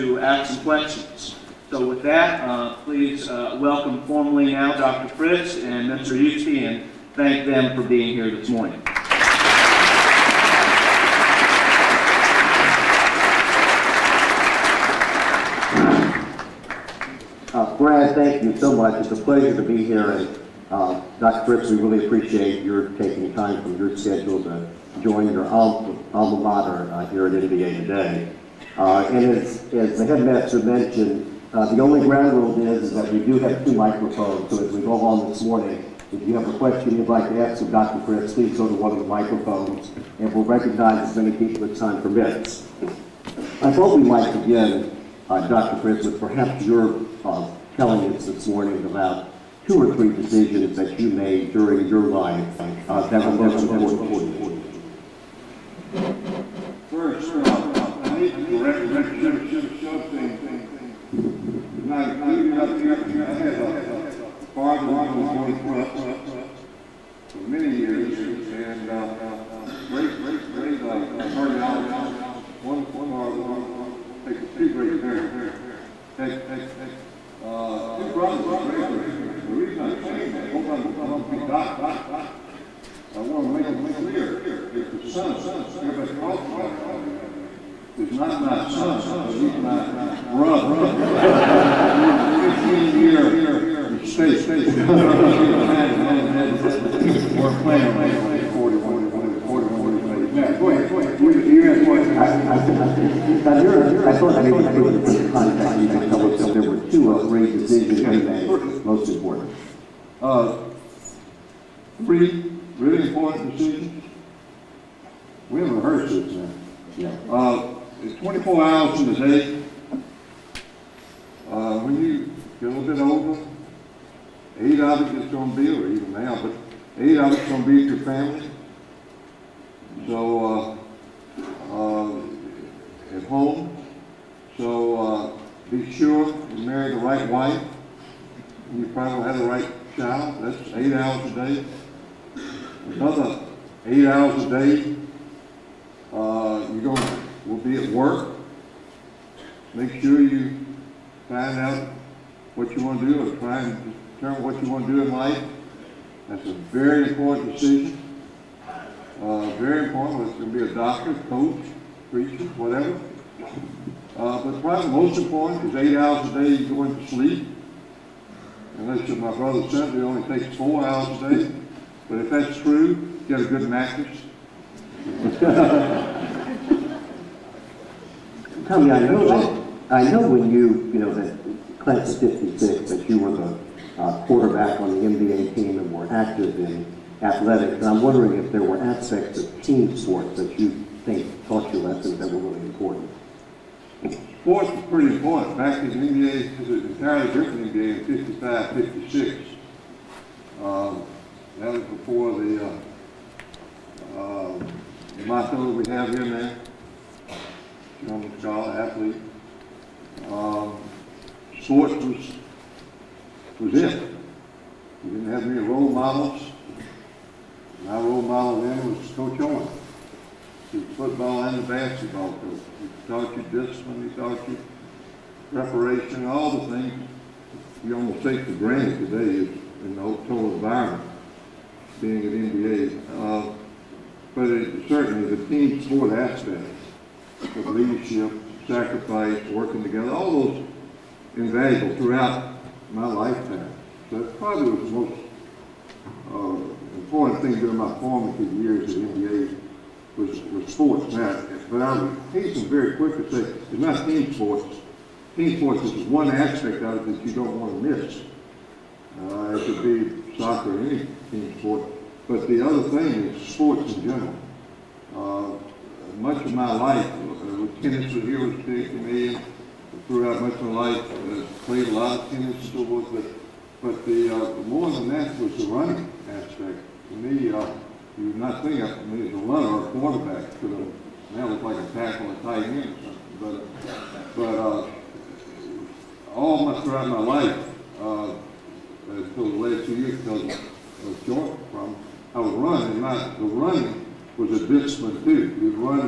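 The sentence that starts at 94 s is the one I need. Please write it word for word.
He's year behind him, mother and dad weren't playing with him when they were 41, when they were 41 years old.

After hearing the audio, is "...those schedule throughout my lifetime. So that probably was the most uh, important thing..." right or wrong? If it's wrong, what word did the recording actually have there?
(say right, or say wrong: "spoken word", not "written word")
wrong: "invaluable", not "schedule".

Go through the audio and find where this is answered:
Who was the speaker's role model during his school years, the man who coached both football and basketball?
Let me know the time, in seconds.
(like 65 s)
219 s.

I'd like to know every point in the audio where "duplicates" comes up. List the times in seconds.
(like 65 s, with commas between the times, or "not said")
not said.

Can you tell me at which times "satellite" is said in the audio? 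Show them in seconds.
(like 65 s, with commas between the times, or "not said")
not said.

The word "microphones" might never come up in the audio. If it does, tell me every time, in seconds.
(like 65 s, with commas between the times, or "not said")
33 s, 39 s.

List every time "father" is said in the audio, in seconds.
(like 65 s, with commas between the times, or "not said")
64 s, 73 s.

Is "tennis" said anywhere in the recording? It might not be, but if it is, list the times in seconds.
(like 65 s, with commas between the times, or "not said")
267 s, 272 s.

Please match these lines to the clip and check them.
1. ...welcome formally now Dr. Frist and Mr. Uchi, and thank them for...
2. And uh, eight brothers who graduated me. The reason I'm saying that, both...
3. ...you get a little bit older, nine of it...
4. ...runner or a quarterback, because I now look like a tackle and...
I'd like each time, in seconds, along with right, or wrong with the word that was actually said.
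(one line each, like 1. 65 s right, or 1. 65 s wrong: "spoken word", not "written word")
1. 3 s right
2. 76 s wrong: "two", not "eight"
3. 122 s wrong: "eight", not "nine"
4. 279 s right.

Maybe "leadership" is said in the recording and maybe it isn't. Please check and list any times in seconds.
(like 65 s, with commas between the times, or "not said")
237 s.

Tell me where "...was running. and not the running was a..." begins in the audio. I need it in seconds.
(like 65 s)
292 s.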